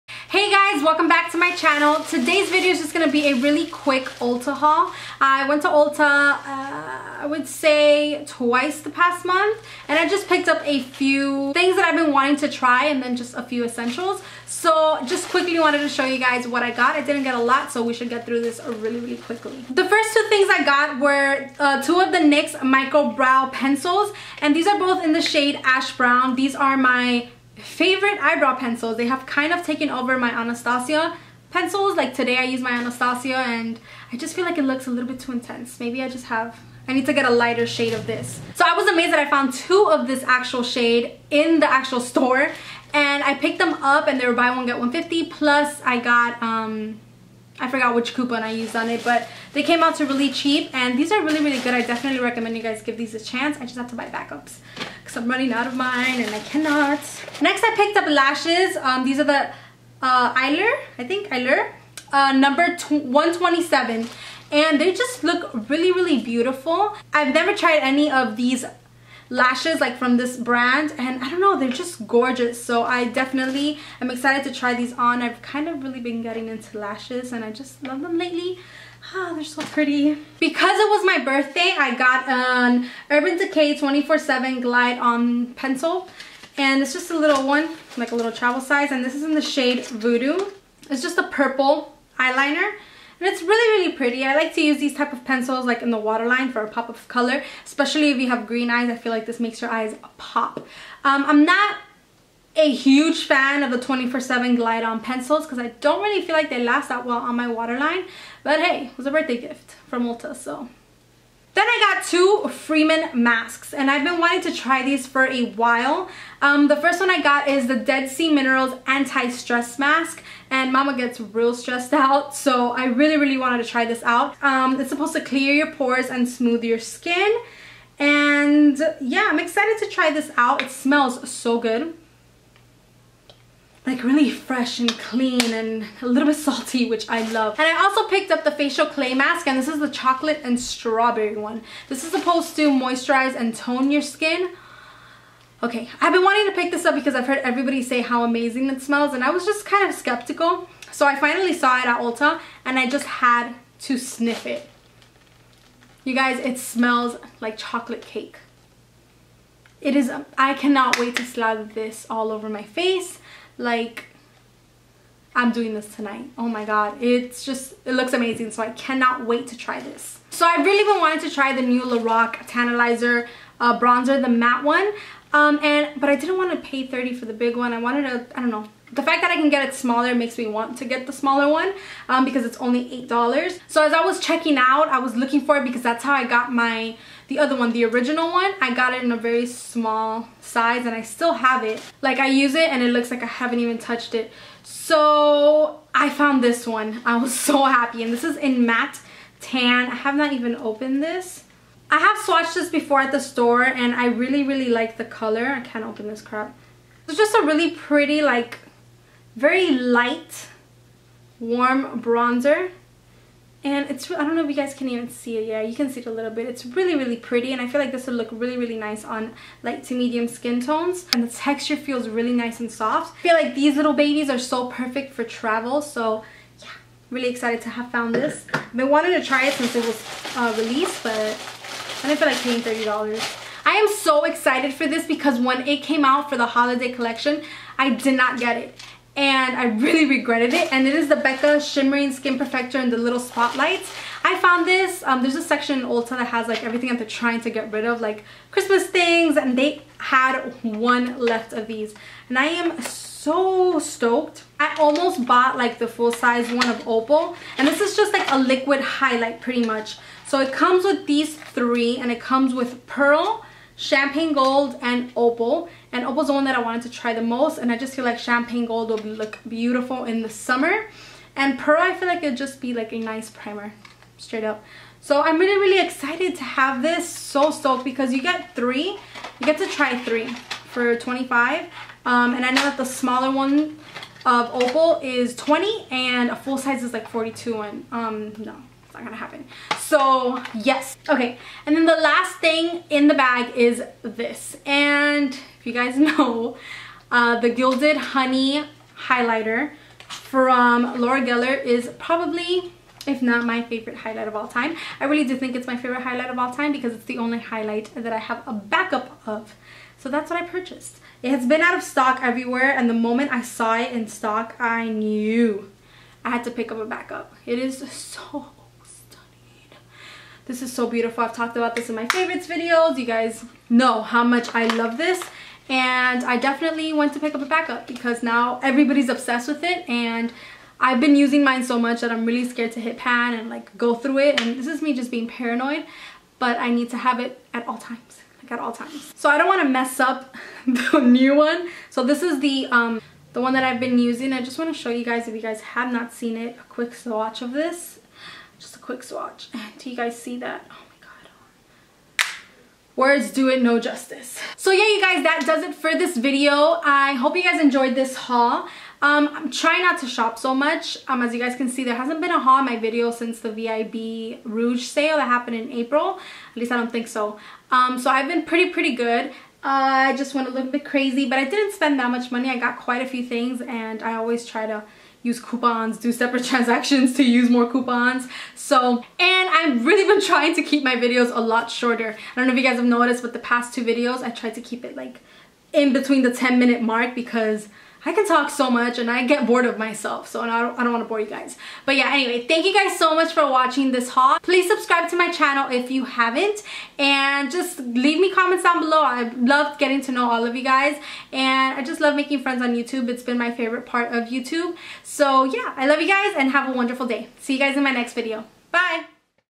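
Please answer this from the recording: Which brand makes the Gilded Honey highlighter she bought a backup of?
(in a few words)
Laura Geller.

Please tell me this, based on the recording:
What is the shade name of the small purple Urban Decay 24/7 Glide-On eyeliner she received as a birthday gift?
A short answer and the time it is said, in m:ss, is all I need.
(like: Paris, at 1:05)
Voodoo, at 1:29.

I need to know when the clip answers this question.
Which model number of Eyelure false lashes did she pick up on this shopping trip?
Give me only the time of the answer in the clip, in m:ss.
1:02.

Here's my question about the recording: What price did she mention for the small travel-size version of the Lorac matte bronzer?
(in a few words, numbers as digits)
$8.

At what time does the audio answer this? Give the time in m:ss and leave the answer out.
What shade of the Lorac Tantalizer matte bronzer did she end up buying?
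3:18.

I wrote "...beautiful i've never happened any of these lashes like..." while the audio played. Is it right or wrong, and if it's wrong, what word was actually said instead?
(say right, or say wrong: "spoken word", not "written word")
wrong: "tried", not "happened".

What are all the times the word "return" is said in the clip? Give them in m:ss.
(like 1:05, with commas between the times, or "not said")
not said.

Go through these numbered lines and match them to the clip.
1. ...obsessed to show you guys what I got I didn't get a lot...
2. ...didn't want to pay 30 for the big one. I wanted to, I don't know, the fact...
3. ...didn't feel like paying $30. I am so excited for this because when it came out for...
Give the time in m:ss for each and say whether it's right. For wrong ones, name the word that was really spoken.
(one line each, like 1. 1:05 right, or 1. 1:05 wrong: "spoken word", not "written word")
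1. 0:15 wrong: "wanted", not "obsessed"
2. 2:56 right
3. 3:52 right.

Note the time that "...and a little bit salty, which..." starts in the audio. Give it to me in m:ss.
2:15.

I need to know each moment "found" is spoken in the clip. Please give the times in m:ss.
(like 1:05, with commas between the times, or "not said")
0:39, 3:16, 3:47, 4:04.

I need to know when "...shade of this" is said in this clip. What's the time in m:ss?
0:37.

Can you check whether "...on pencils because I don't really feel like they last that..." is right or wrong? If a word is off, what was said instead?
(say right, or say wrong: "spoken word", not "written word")
right.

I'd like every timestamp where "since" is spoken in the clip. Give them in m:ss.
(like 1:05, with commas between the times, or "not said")
3:49, 6:03.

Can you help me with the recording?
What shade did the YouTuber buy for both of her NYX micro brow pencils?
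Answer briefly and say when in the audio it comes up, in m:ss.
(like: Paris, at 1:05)
Ash brown, at 0:25.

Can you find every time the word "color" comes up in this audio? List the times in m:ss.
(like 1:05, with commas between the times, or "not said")
1:37, 3:25.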